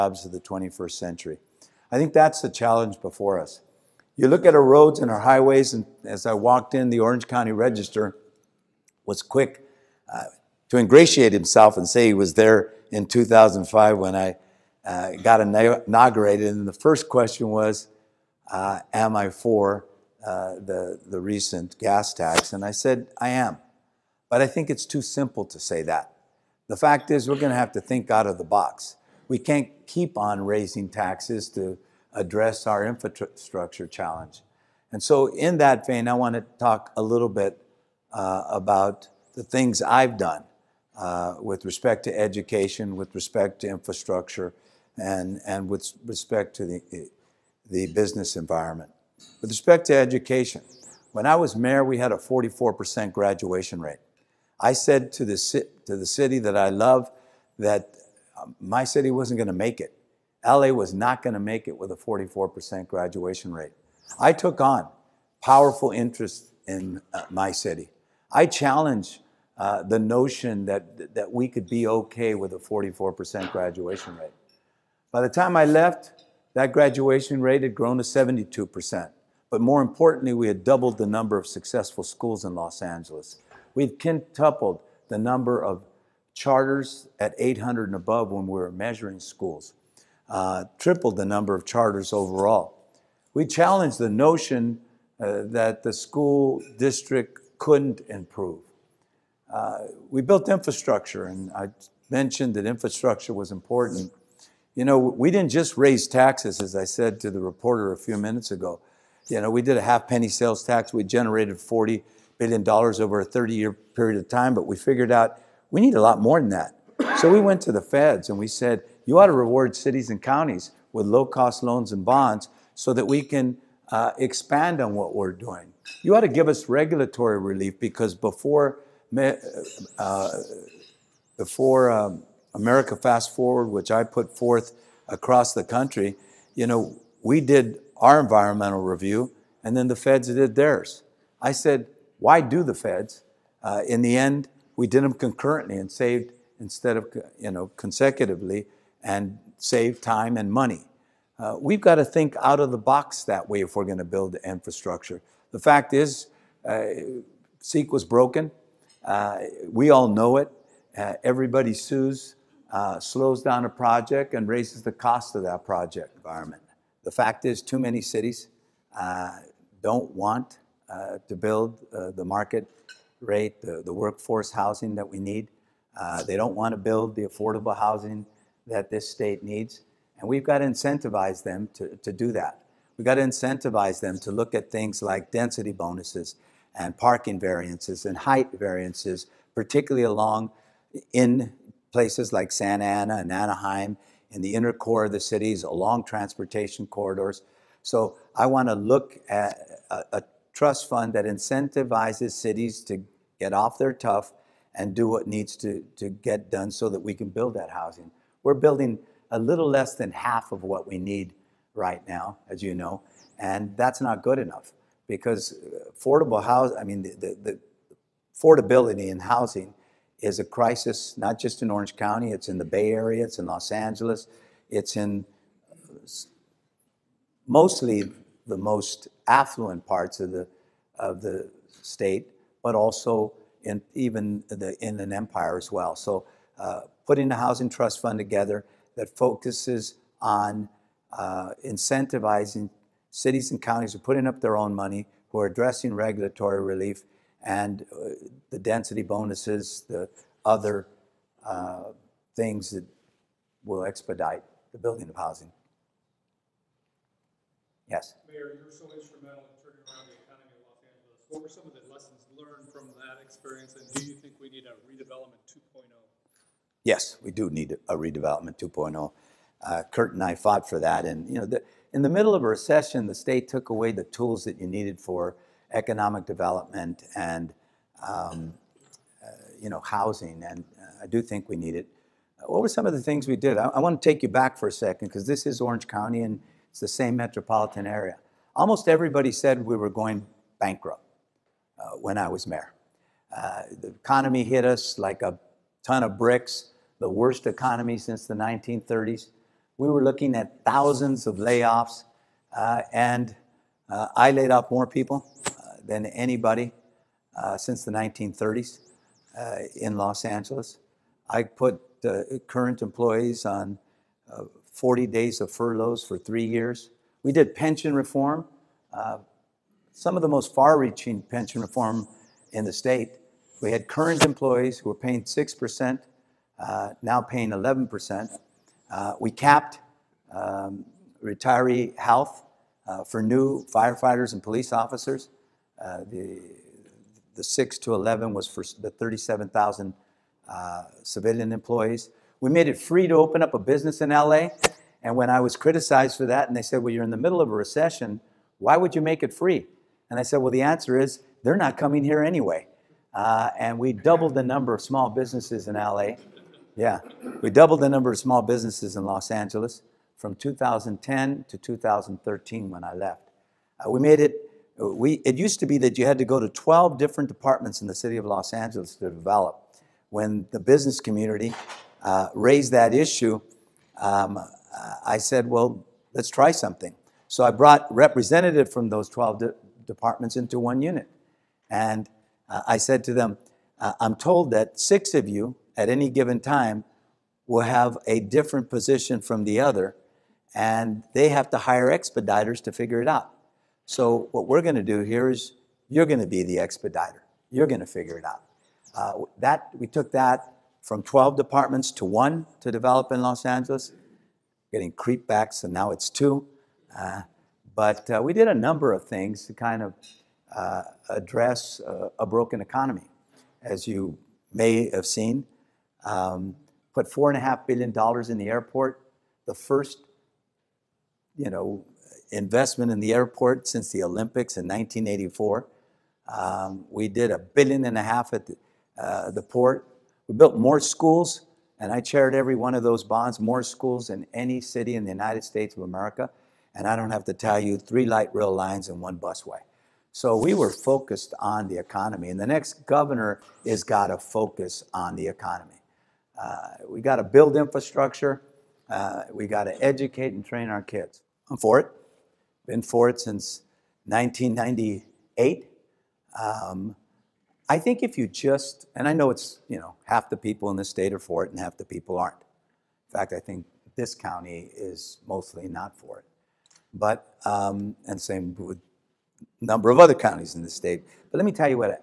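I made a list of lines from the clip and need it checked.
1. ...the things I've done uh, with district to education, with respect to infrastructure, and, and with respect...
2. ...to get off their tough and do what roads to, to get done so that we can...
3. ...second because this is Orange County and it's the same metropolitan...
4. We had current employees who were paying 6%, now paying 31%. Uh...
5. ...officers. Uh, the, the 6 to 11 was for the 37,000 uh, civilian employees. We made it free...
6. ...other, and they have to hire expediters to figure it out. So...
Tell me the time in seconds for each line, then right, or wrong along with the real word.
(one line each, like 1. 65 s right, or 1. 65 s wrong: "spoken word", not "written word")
1. 39 s wrong: "respect", not "district"
2. 202 s wrong: "needs", not "roads"
3. 284 s right
4. 323 s wrong: "11", not "31"
5. 334 s right
6. 389 s right.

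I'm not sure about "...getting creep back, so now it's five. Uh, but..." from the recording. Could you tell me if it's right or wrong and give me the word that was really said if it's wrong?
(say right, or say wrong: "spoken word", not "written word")
wrong: "two", not "five".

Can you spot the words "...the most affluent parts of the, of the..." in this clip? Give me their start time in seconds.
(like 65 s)
228 s.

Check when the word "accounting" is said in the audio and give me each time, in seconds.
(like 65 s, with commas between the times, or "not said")
not said.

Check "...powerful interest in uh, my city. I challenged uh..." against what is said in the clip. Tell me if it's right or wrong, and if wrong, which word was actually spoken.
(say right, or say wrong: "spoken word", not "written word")
right.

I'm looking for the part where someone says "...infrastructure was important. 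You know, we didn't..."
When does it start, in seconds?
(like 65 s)
102 s.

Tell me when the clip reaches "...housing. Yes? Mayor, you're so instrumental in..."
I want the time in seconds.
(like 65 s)
255 s.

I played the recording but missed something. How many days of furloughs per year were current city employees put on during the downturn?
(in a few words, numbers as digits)
40 days.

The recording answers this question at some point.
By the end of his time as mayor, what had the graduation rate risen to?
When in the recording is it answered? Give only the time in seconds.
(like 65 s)
78 s.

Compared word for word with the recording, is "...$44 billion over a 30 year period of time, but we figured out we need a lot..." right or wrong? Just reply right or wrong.
wrong.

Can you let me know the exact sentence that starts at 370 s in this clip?
When the business community uh, raised that issue, um, I said, well, let's try something.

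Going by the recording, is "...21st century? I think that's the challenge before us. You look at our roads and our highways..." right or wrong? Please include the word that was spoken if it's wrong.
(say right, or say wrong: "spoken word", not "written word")
right.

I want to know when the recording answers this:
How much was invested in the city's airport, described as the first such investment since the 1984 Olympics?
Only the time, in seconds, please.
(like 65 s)
417 s.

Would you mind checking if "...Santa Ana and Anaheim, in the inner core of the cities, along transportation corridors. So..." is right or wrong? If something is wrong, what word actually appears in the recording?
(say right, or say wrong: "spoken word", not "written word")
right.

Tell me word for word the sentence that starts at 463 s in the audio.
In fact, I think this county is mostly not for it.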